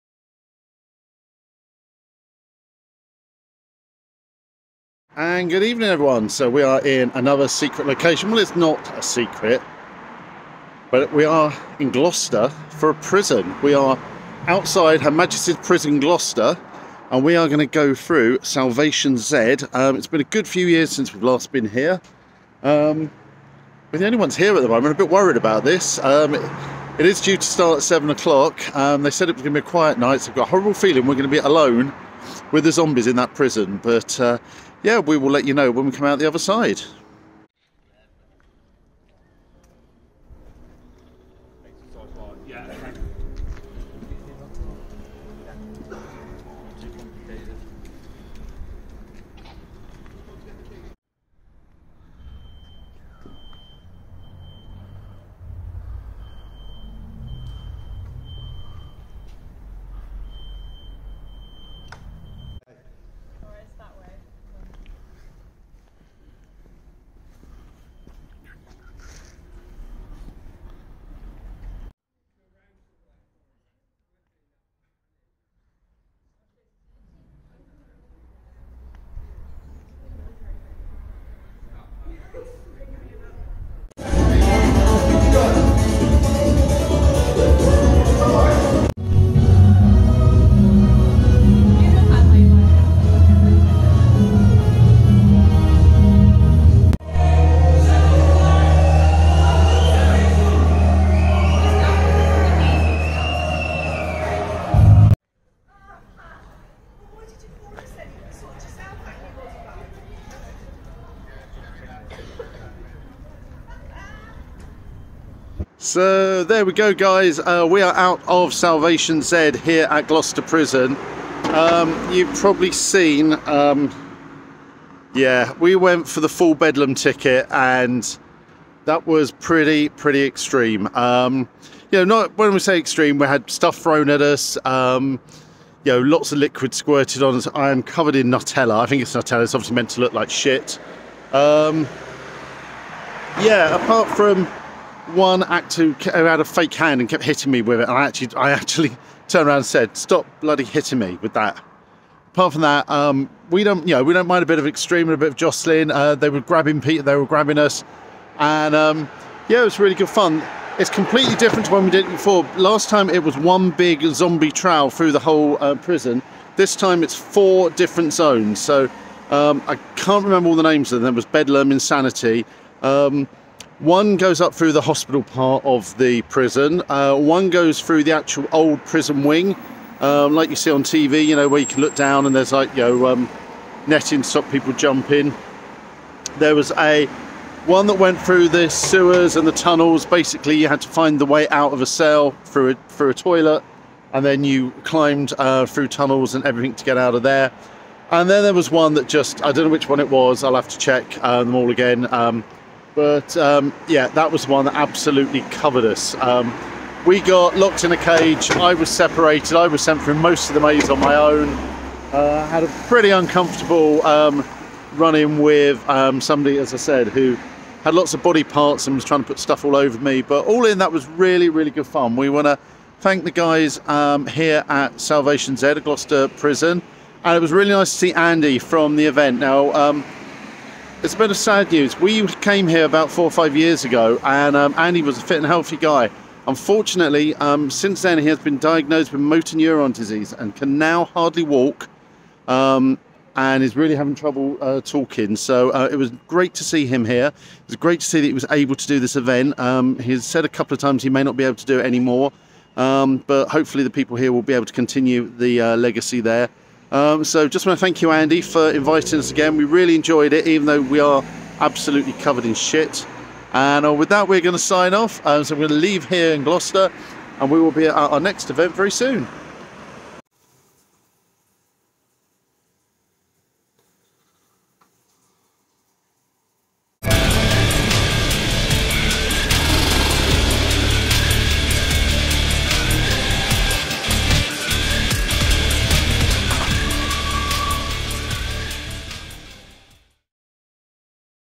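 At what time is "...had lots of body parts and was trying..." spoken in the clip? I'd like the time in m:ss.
3:37.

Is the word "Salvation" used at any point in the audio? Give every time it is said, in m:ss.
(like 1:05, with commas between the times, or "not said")
0:18, 1:58, 3:44.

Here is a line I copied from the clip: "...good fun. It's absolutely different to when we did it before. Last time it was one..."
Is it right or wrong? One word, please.
wrong.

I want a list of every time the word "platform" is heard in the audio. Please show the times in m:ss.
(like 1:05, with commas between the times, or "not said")
not said.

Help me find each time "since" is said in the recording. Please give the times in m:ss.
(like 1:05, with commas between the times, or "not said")
0:20, 3:57.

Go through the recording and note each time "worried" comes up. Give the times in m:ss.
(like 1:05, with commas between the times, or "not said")
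0:25.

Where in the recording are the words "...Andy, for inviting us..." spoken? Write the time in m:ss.
4:18.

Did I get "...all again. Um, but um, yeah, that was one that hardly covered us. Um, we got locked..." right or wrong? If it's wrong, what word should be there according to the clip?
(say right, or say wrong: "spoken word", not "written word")
wrong: "absolutely", not "hardly".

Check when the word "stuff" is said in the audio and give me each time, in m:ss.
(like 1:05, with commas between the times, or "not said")
2:13, 3:39.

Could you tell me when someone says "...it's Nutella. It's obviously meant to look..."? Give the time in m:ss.
2:19.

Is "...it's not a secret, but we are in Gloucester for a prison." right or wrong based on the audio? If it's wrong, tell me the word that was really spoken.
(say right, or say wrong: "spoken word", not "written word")
right.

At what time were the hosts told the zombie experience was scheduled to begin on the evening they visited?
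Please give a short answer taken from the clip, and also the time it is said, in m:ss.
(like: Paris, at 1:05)
7 o'clock, at 0:27.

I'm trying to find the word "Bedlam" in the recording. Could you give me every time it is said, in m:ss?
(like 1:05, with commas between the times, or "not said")
2:06, 2:51.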